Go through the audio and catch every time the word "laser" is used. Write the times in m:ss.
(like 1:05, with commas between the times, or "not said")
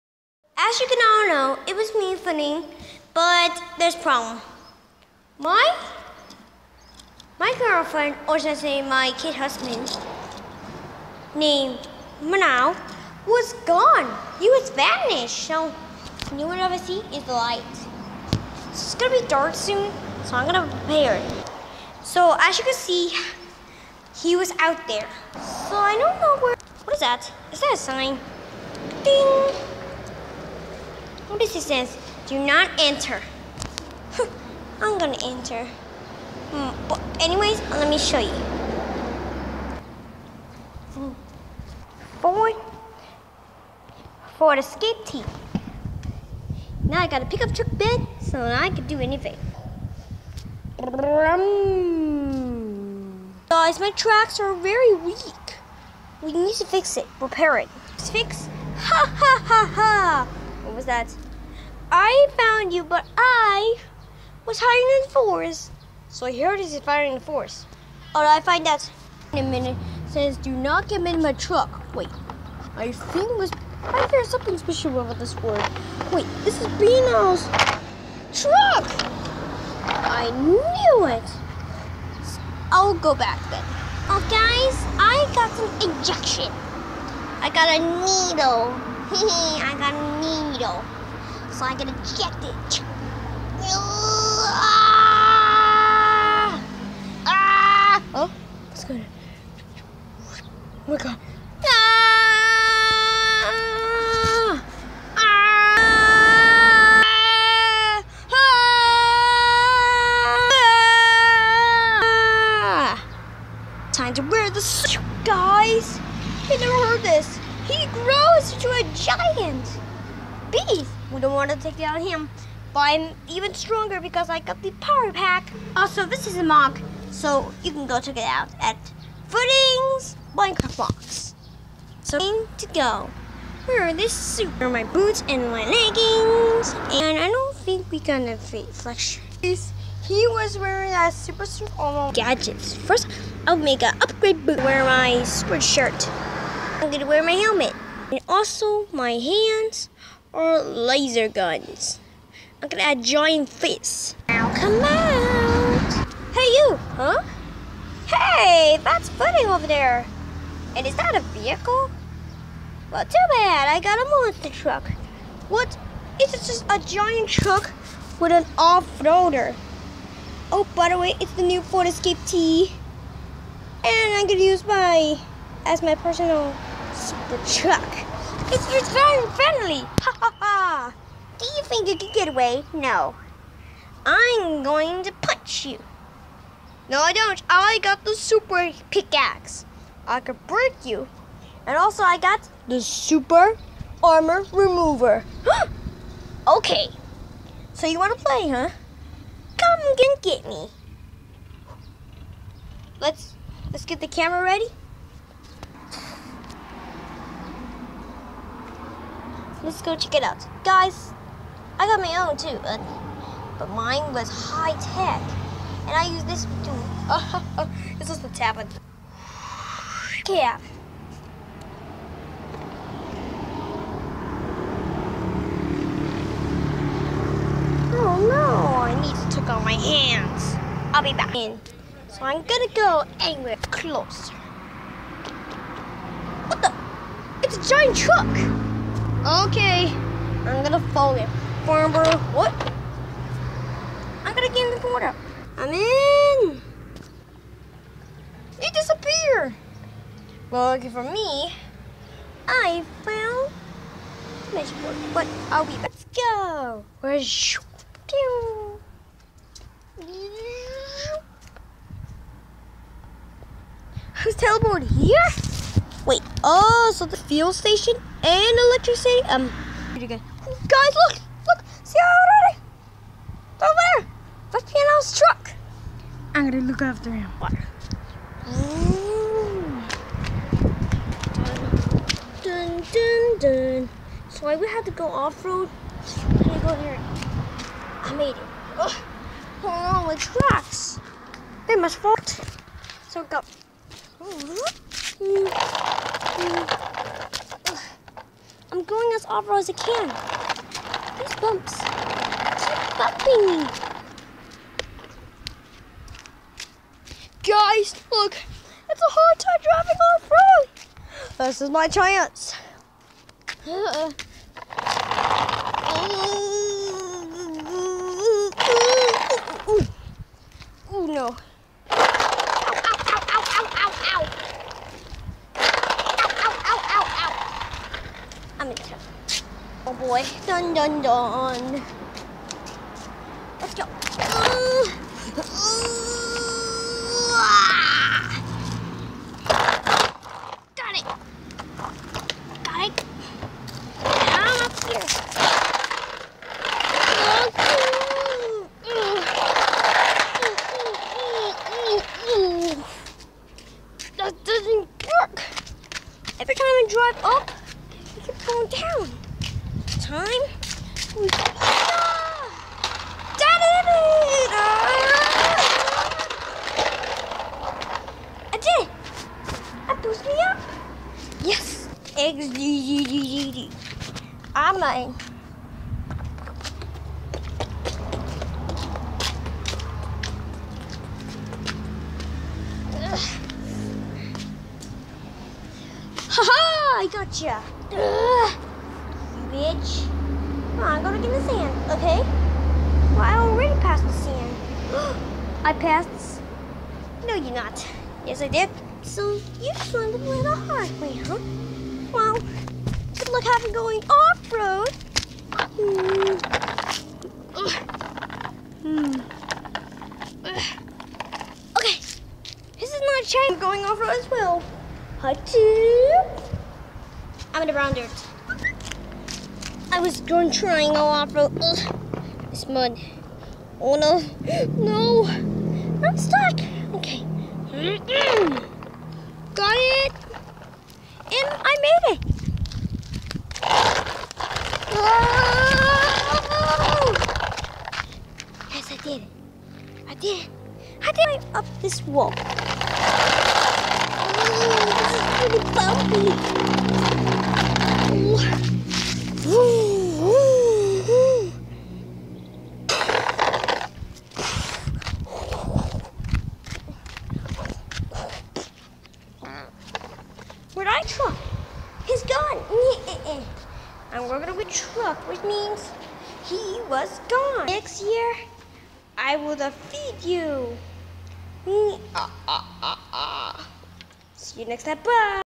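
2:30.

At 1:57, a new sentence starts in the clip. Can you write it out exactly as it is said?
He grows into a giant bees.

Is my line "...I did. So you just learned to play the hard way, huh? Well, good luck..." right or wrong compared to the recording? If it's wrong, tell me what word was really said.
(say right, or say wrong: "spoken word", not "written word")
right.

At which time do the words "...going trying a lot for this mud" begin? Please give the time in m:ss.
7:00.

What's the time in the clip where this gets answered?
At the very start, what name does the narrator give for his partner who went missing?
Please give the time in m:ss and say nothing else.
0:12.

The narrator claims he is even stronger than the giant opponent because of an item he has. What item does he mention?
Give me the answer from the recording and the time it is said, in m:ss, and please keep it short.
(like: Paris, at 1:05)
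Power pack, at 2:04.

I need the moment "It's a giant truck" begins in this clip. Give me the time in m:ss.
3:57.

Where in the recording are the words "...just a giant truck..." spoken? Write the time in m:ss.
2:46.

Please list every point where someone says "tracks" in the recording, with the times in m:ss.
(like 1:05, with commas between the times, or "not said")
0:53, 4:50.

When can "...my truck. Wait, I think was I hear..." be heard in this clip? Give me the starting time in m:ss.
1:11.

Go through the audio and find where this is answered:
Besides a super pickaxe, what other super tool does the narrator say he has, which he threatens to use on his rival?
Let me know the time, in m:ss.
3:12.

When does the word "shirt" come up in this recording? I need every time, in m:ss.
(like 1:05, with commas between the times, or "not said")
2:25.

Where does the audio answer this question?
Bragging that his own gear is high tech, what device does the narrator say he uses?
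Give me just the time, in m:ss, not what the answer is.
3:38.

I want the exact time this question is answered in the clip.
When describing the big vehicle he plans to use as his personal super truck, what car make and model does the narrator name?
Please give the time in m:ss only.
2:51.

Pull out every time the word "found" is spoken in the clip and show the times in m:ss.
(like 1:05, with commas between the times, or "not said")
1:02, 4:13.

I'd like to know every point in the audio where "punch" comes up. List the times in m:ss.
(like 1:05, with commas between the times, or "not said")
3:05.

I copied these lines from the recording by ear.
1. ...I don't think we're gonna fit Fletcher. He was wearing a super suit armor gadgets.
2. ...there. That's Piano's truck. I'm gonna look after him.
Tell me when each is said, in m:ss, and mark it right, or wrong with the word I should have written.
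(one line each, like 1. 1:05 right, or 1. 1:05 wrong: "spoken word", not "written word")
1. 2:17 right
2. 4:33 right.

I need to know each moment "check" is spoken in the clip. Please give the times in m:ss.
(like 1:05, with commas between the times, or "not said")
2:07, 3:29.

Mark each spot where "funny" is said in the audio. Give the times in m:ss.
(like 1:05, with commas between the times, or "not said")
0:02, 2:39.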